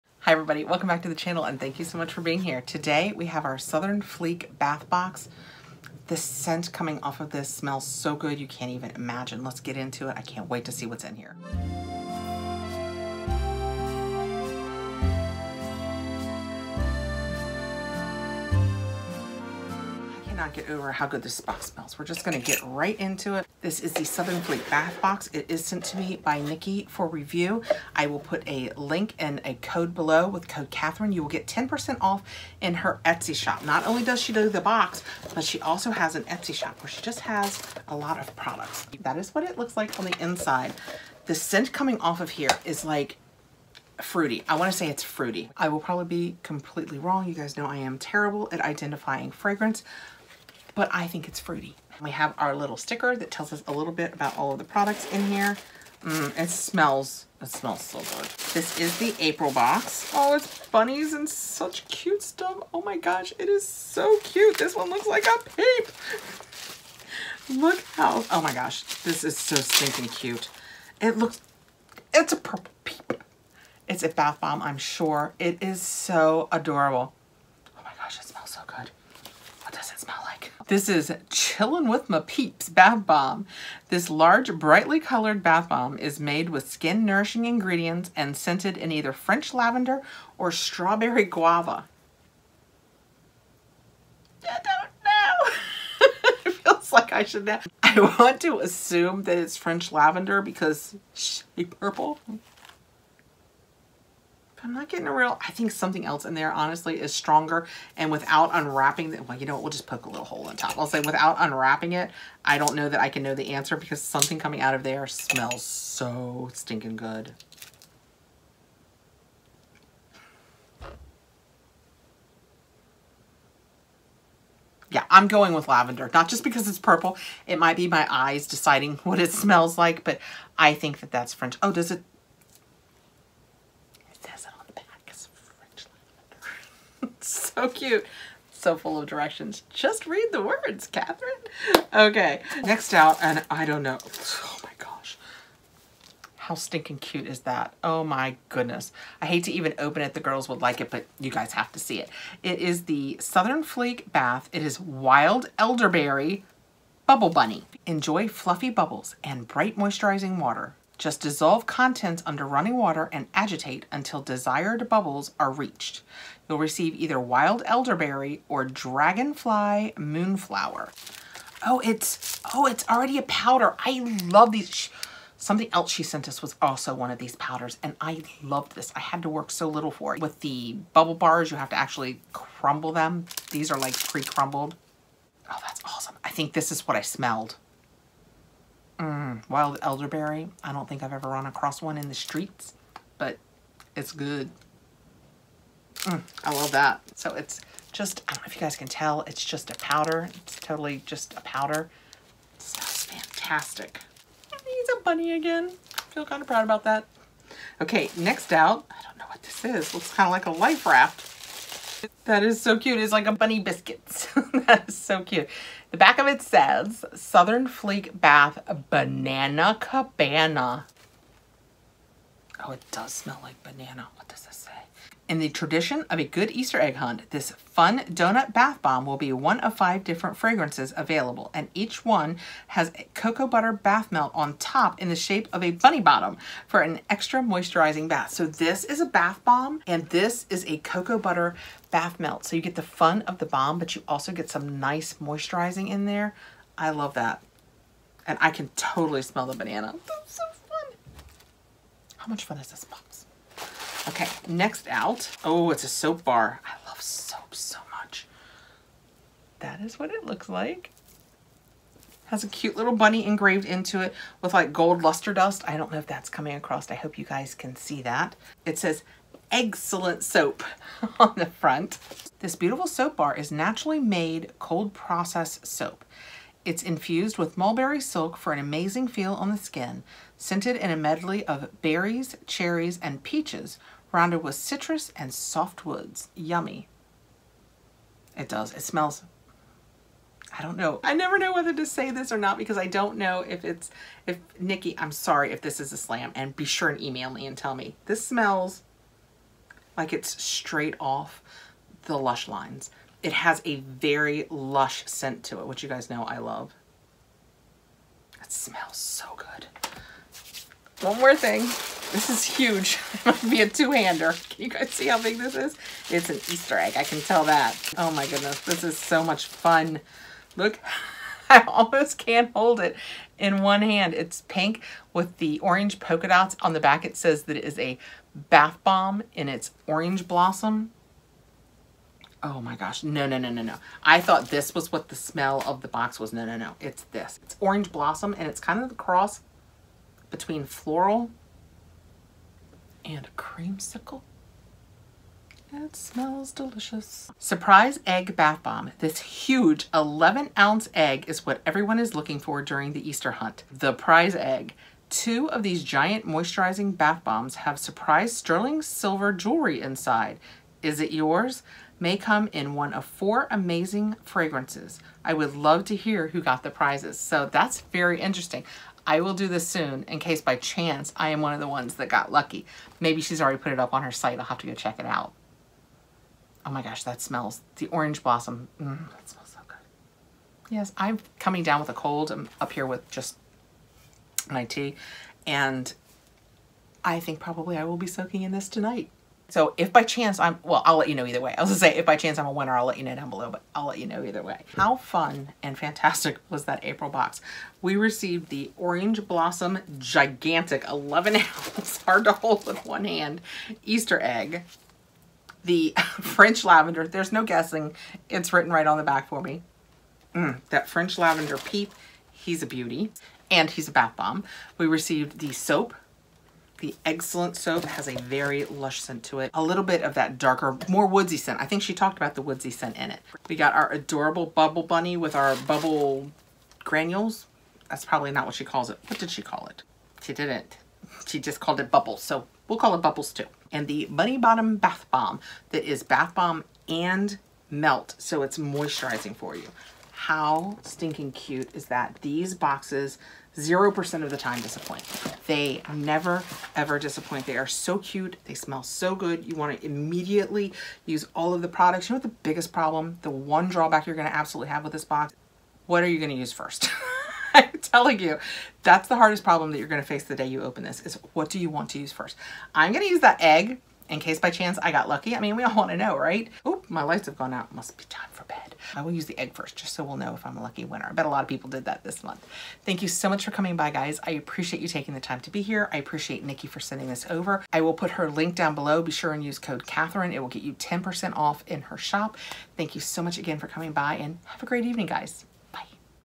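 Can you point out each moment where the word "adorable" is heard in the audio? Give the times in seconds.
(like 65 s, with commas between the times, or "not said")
76 s, 423 s.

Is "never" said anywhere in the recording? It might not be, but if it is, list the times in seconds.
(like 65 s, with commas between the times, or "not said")
291 s, 445 s.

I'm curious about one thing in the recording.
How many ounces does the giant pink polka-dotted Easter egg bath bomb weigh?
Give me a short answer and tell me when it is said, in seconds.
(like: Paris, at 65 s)
11, at 349 s.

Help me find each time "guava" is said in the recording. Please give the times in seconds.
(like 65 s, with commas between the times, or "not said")
91 s.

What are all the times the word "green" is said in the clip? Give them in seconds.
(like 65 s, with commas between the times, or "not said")
not said.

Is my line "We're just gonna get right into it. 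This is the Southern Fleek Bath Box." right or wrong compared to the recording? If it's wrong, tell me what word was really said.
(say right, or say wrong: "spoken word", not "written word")
right.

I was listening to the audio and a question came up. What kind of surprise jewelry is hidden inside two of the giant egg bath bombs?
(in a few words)
Sterling silver.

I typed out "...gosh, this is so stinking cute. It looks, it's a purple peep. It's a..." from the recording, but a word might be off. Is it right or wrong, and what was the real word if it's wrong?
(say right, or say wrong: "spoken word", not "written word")
right.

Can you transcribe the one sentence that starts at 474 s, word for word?
I appreciate you taking the time to be here.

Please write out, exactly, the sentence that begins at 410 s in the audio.
Mm, that French lavender peep, he's a beauty.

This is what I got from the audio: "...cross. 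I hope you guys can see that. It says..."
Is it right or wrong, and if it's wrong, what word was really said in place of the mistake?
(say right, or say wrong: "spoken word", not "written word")
wrong: "across", not "cross".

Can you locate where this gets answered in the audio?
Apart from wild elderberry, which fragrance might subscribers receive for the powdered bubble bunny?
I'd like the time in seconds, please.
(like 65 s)
168 s.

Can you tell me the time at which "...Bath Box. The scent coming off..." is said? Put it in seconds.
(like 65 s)
4 s.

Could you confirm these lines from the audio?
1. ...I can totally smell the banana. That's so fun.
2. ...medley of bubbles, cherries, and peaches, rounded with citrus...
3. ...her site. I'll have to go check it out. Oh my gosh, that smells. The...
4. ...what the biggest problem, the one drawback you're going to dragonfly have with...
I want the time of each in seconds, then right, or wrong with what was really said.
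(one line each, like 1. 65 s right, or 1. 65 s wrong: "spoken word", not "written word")
1. 248 s right
2. 280 s wrong: "berries", not "bubbles"
3. 374 s right
4. 452 s wrong: "absolutely", not "dragonfly".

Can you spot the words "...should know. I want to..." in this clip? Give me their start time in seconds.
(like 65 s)
97 s.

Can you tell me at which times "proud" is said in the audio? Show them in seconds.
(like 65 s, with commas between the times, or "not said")
206 s.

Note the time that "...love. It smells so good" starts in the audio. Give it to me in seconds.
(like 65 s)
306 s.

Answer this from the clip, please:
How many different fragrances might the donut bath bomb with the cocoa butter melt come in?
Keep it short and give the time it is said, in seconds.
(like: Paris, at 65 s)
5, at 229 s.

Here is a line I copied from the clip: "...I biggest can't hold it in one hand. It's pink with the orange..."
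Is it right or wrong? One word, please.
wrong.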